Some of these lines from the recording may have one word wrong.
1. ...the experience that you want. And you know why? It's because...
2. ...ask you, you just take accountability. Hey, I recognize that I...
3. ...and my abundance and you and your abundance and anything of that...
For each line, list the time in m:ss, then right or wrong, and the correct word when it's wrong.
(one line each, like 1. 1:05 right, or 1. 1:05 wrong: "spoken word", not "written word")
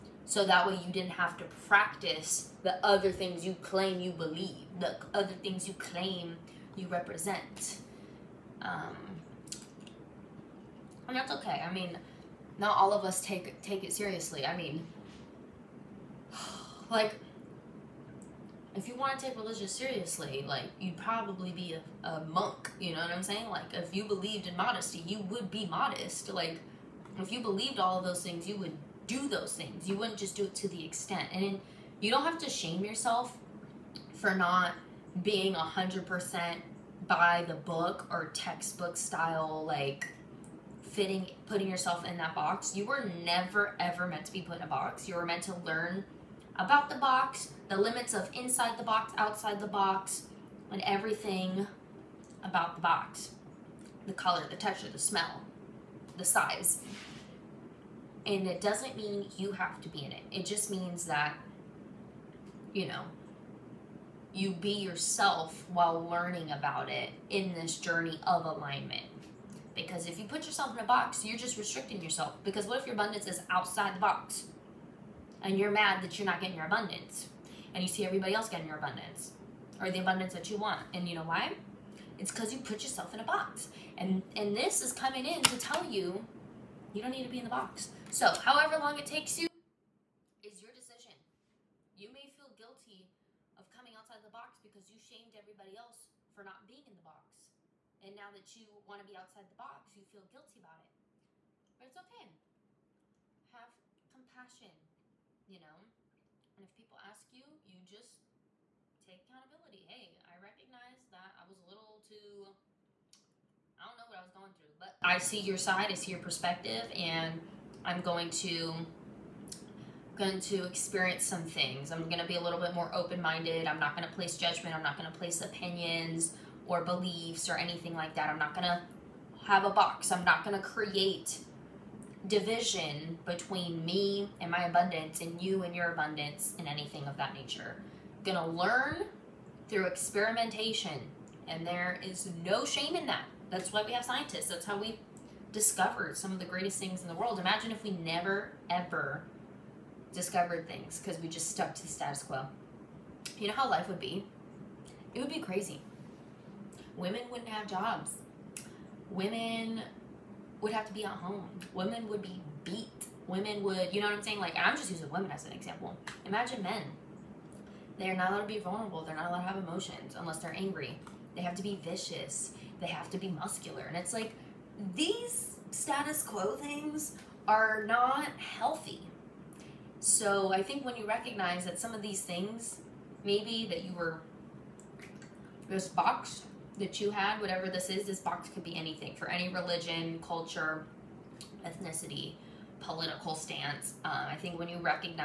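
1. 1:19 wrong: "abundance", not "experience"
2. 1:46 right
3. 2:14 right.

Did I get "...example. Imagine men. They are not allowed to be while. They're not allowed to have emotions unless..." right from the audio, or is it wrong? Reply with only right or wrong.
wrong.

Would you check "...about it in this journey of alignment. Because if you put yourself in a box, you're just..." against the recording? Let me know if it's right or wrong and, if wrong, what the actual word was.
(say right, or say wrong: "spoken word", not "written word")
right.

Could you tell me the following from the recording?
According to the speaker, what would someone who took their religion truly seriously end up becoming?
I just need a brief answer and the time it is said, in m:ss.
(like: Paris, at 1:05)
a monk, at 0:22.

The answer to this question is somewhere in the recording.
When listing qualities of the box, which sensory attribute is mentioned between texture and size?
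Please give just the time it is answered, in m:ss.
0:54.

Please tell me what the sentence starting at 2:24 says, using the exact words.
That's how we discovered some of the greatest things in the world.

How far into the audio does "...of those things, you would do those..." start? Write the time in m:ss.
0:27.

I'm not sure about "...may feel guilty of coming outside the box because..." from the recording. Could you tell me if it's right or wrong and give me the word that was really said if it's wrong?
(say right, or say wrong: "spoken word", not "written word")
right.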